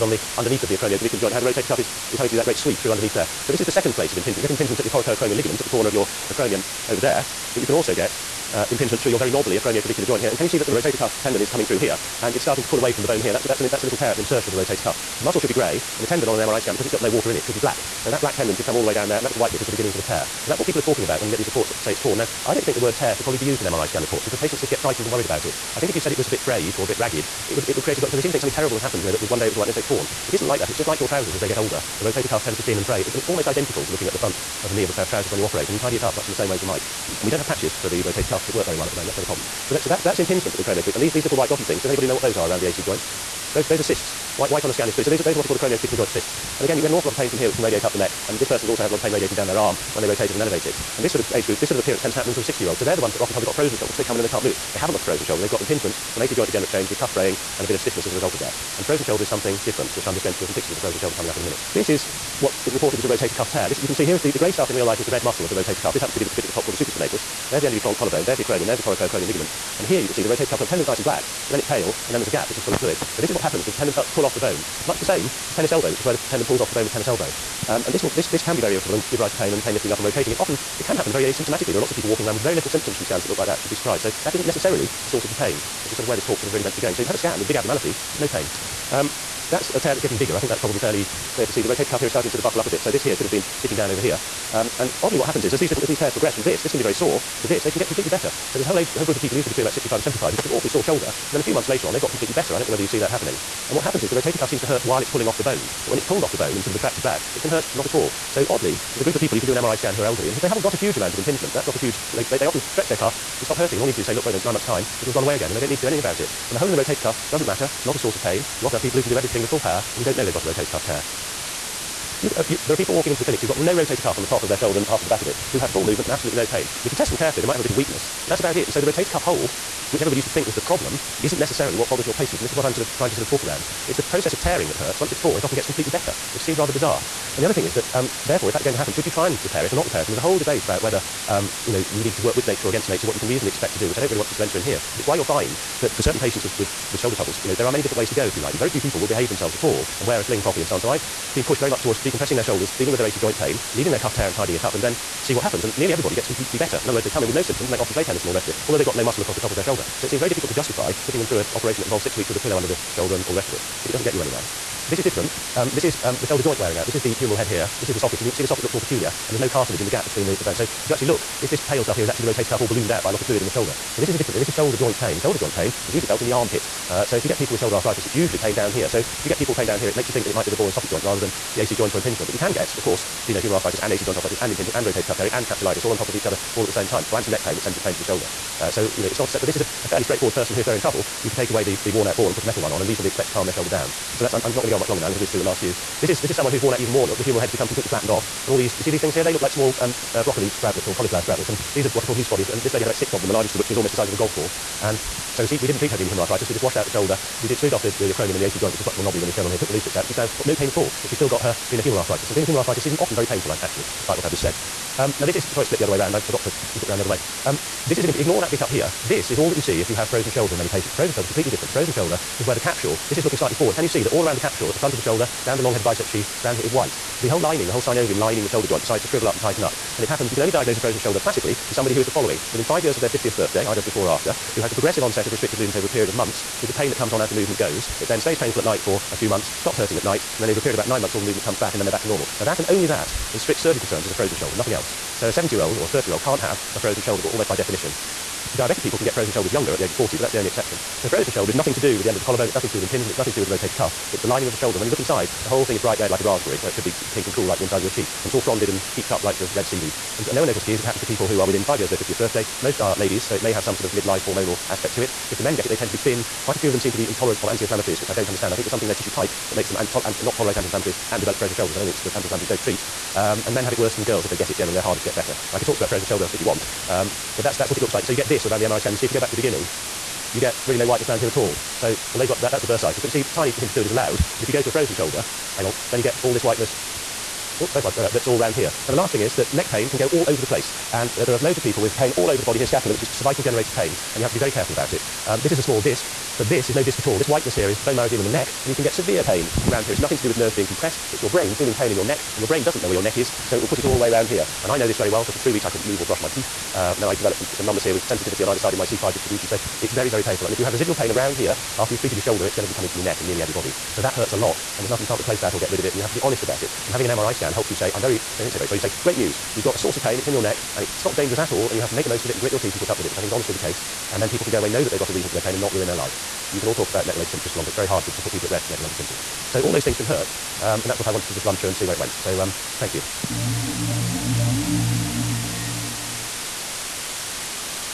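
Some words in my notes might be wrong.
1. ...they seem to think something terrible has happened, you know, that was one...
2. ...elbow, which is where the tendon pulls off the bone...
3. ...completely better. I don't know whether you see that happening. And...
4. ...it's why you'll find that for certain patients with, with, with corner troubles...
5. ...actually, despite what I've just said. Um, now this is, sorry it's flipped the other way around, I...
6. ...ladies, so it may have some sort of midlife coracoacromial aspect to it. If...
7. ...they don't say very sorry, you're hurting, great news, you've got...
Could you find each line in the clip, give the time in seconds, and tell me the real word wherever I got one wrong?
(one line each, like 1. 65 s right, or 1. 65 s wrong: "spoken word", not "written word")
1. 28 s right
2. 75 s right
3. 102 s right
4. 145 s wrong: "shoulder", not "corner"
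5. 213 s right
6. 262 s wrong: "hormonal", not "coracoacromial"
7. 318 s wrong: "saying", not "hurting".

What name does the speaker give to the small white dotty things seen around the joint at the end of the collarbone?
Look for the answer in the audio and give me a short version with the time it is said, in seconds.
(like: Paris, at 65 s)
acromioclavicular joint cysts, at 45 s.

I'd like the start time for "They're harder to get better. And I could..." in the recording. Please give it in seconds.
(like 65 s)
274 s.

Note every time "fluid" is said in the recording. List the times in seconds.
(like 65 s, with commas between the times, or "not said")
44 s, 72 s, 173 s, 283 s.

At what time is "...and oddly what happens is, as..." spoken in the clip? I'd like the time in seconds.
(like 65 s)
94 s.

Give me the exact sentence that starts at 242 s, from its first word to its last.
Now, that and only that, in strict surgical terms, is a frozen shoulder, nothing else.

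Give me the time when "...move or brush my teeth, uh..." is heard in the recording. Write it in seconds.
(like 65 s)
305 s.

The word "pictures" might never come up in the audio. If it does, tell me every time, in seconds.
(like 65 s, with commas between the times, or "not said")
60 s.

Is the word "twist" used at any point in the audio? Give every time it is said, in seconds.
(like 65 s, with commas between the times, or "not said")
not said.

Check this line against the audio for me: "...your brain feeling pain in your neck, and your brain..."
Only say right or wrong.
right.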